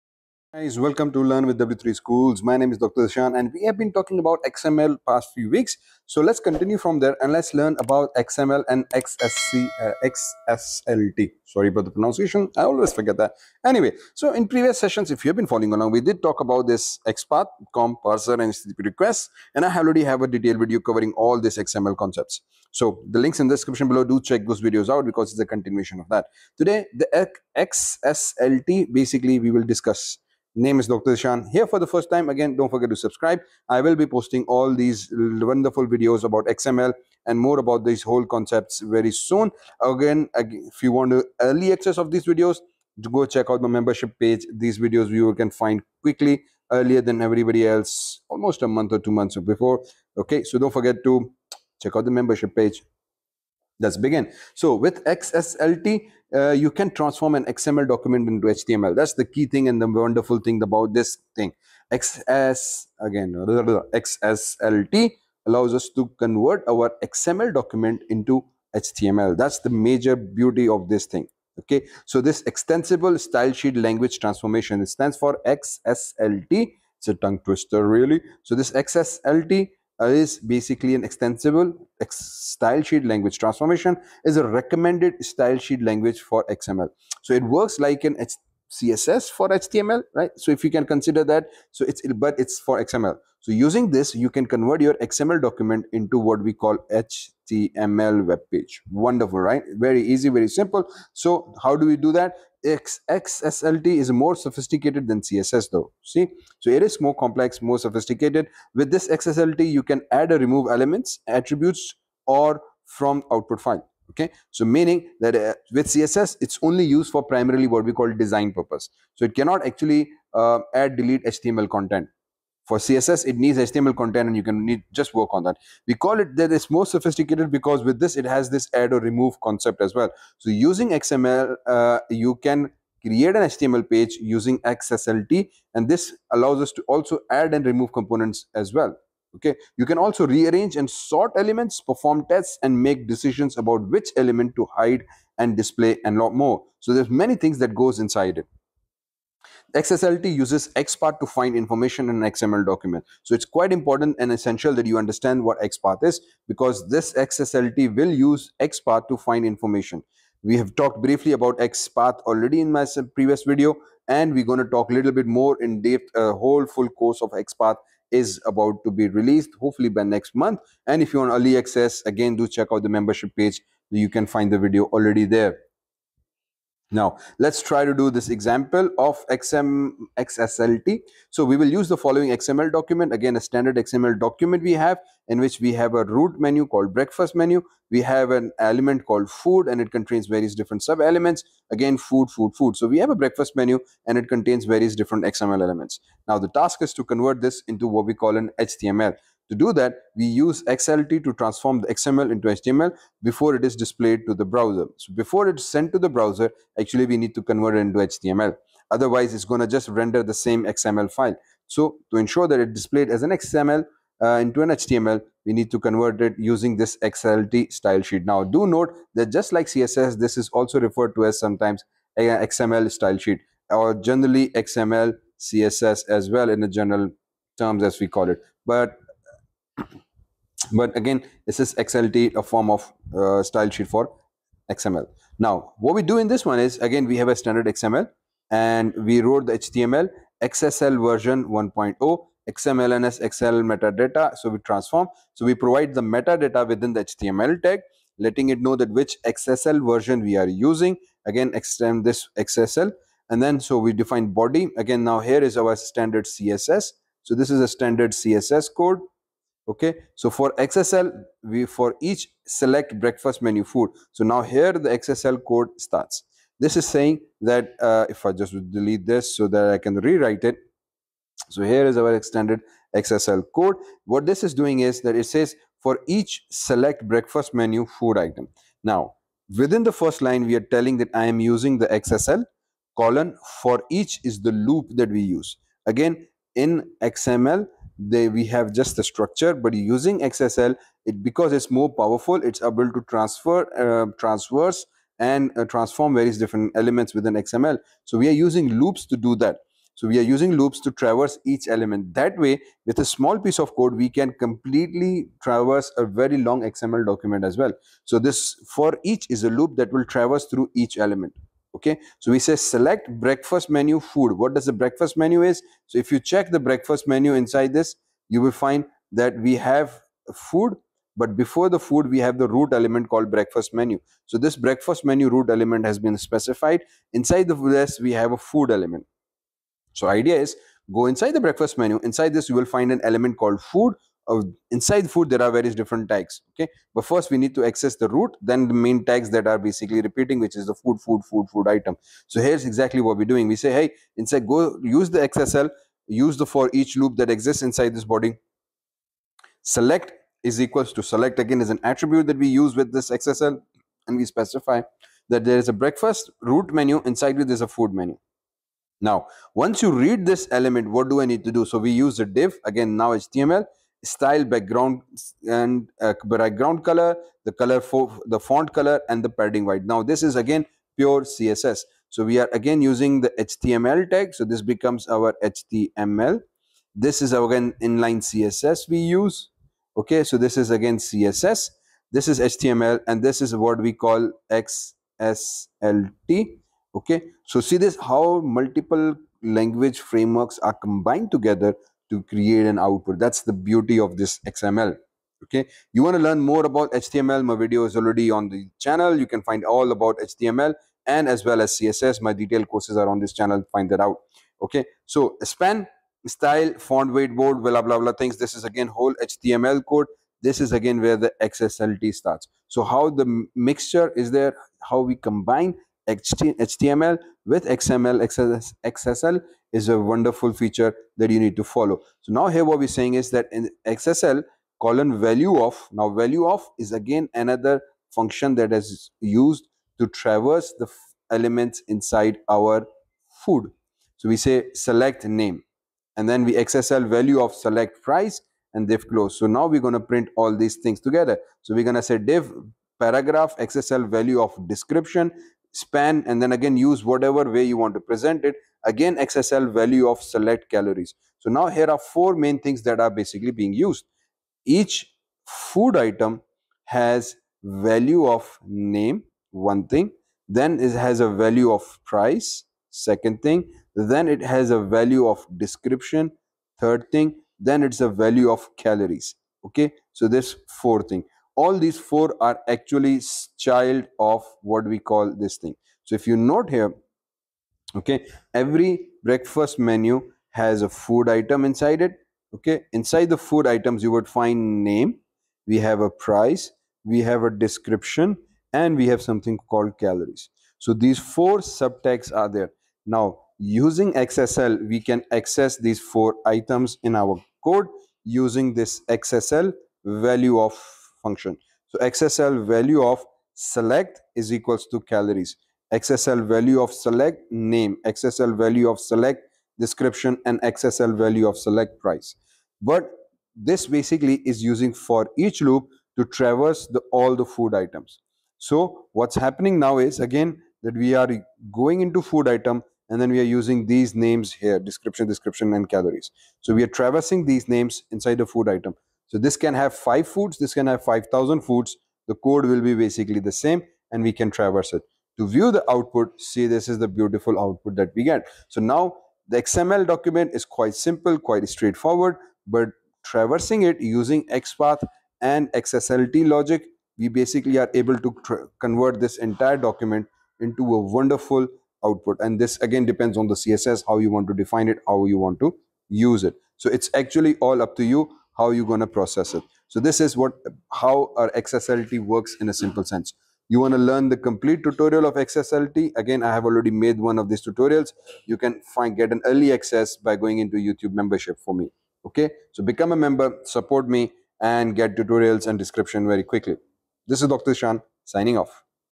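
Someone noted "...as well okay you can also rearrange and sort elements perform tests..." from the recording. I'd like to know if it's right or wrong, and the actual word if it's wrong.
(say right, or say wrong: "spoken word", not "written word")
right.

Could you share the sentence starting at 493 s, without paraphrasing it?
Now using XSL, we can access these four items in our code using this XSL value of function.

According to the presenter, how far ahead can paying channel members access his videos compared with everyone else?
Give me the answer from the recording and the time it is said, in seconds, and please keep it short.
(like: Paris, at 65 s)
a month or two, at 48 s.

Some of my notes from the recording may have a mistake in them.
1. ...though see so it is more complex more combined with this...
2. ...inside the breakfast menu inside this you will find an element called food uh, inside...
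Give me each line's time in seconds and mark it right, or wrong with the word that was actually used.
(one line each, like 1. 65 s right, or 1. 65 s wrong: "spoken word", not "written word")
1. 105 s wrong: "sophisticated", not "combined"
2. 331 s right.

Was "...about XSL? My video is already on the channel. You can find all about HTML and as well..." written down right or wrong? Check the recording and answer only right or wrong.
wrong.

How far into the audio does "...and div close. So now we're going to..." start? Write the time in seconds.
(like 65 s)
438 s.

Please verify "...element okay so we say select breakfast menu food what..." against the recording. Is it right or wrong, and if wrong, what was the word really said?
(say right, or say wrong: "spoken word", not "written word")
right.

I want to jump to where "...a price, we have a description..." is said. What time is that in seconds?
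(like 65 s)
486 s.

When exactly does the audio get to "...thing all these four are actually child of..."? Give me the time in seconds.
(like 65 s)
471 s.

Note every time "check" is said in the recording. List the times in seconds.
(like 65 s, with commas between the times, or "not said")
24 s, 43 s, 51 s, 172 s, 316 s.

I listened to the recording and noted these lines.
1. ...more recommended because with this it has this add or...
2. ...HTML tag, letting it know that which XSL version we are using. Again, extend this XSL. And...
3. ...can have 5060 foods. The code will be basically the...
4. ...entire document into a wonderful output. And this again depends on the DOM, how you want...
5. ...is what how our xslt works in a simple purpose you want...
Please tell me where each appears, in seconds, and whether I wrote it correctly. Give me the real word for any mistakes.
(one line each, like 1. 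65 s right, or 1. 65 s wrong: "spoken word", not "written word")
1. 126 s wrong: "sophisticated", not "recommended"
2. 247 s right
3. 530 s wrong: "5000", not "5060"
4. 549 s wrong: "CSS", not "DOM"
5. 560 s wrong: "sense", not "purpose".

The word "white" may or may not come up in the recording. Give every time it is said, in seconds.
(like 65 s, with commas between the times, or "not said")
369 s.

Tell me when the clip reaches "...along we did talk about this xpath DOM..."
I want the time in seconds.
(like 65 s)
15 s.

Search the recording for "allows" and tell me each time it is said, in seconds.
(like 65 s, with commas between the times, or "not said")
65 s, 136 s.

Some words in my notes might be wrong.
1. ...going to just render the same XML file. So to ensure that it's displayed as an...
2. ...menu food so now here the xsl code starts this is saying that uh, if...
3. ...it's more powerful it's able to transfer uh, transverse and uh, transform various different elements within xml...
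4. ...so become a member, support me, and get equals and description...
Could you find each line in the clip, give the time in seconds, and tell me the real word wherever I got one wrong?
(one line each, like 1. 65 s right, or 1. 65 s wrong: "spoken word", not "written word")
1. 209 s right
2. 263 s right
3. 291 s right
4. 572 s wrong: "tutorials", not "equals".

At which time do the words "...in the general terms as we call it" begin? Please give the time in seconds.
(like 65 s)
226 s.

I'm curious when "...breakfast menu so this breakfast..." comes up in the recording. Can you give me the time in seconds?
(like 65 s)
323 s.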